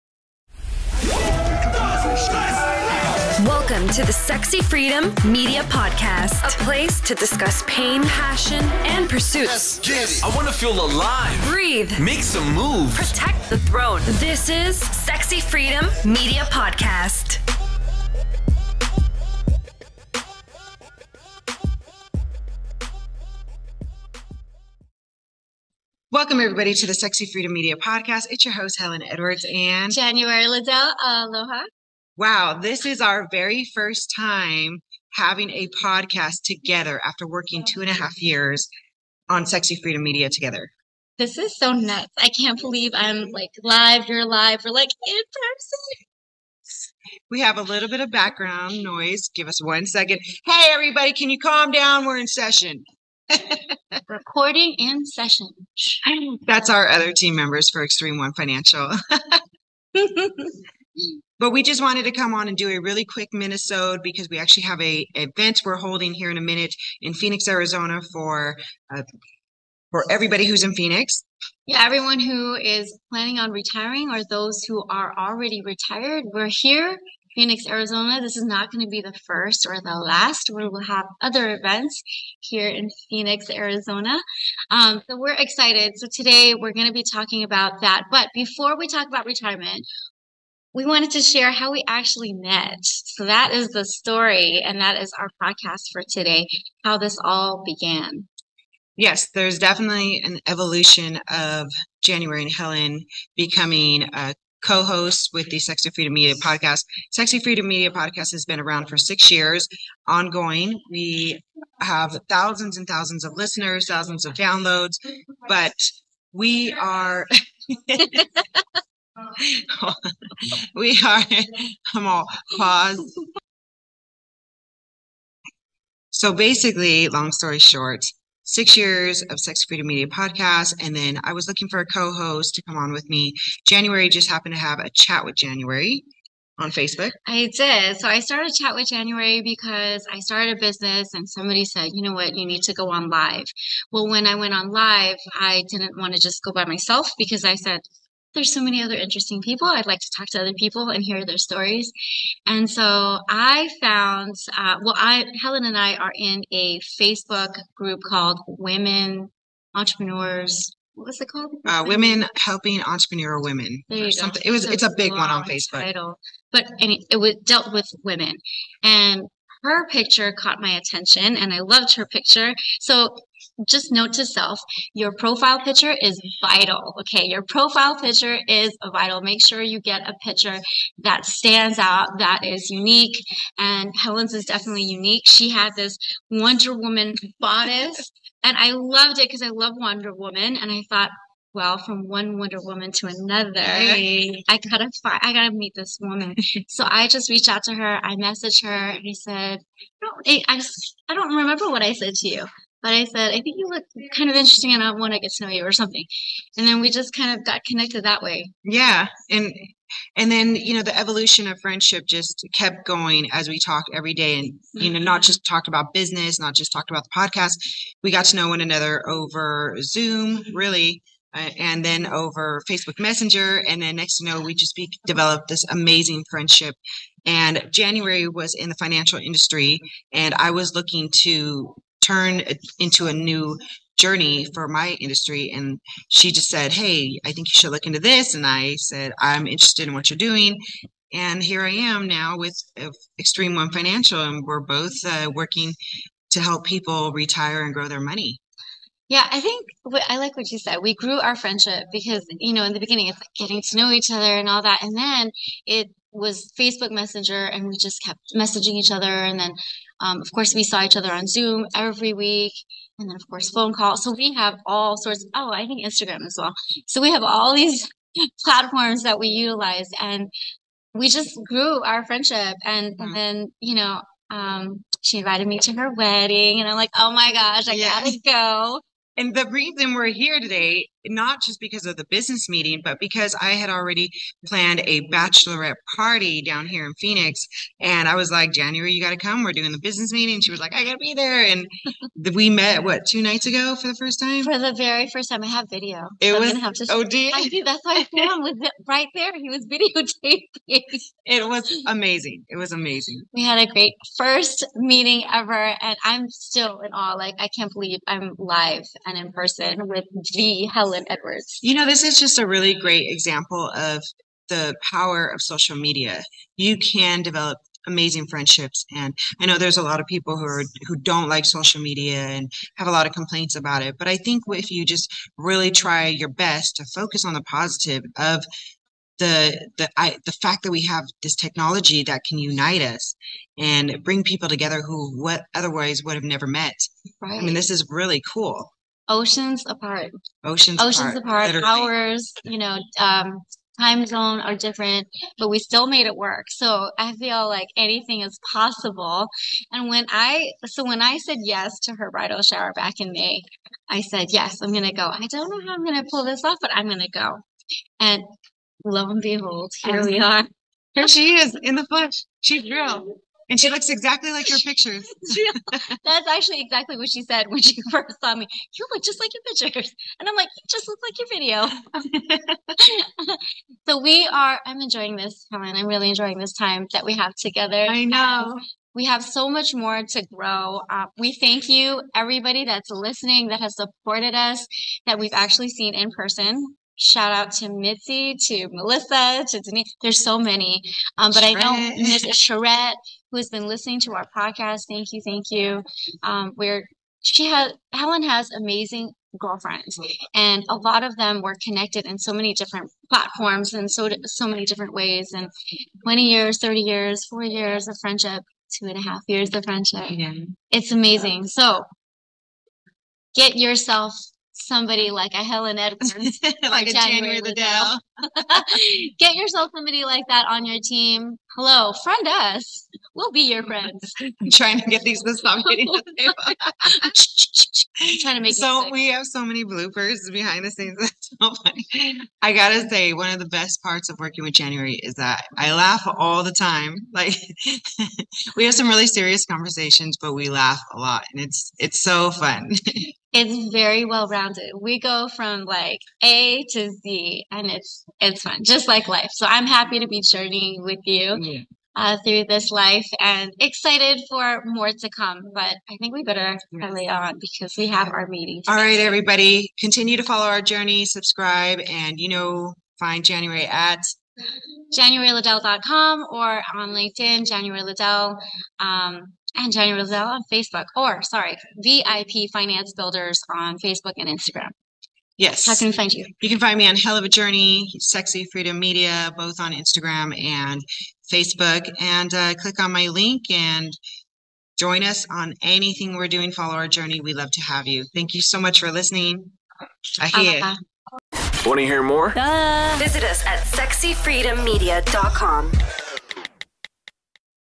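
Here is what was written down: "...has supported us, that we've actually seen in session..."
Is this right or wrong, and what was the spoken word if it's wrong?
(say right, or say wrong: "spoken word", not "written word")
wrong: "person", not "session".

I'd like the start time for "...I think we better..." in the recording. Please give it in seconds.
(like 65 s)
455 s.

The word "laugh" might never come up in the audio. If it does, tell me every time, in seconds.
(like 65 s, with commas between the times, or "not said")
435 s, 440 s.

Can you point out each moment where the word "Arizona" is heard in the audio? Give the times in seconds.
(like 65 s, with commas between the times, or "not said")
67 s, 77 s, 83 s.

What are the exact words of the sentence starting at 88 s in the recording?
But before we talk about retirement, we wanted to share how we actually met.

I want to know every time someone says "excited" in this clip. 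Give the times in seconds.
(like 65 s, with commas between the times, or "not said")
85 s, 453 s.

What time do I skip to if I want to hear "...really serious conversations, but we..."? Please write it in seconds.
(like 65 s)
438 s.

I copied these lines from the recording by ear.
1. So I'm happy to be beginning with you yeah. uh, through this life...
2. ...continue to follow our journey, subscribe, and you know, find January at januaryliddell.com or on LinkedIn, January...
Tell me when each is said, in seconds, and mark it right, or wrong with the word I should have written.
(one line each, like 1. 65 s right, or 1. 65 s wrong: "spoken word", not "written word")
1. 449 s wrong: "journeying", not "beginning"
2. 459 s right.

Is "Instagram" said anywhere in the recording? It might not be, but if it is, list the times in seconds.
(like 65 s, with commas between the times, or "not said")
265 s, 474 s, 479 s.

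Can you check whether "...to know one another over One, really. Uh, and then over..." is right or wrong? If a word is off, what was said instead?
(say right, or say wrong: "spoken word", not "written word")
wrong: "Zoom", not "One".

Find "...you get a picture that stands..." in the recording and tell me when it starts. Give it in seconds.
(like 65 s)
179 s.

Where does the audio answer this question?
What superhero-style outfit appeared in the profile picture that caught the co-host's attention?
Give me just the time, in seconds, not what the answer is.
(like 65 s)
186 s.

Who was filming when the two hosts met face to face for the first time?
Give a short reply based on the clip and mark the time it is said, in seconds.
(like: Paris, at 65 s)
Sam, at 298 s.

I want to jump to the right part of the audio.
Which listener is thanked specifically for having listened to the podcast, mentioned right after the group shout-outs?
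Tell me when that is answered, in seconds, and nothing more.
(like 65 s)
391 s.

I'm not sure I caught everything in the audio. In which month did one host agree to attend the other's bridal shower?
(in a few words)
May.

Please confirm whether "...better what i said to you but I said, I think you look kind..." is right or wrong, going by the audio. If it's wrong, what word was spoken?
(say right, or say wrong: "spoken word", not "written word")
wrong: "remember", not "better".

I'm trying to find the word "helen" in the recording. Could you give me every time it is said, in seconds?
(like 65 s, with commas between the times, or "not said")
28 s, 102 s, 155 s, 183 s, 310 s, 375 s, 397 s, 415 s.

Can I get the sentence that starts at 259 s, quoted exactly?
And then, um, of course, we saw each other on Zoom every week, and then, of course, phone calls.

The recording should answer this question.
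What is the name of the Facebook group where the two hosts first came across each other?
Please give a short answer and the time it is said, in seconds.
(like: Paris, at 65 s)
Women Helping Entrepreneur Women, at 161 s.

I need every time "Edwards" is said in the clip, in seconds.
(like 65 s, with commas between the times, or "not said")
29 s, 311 s, 415 s.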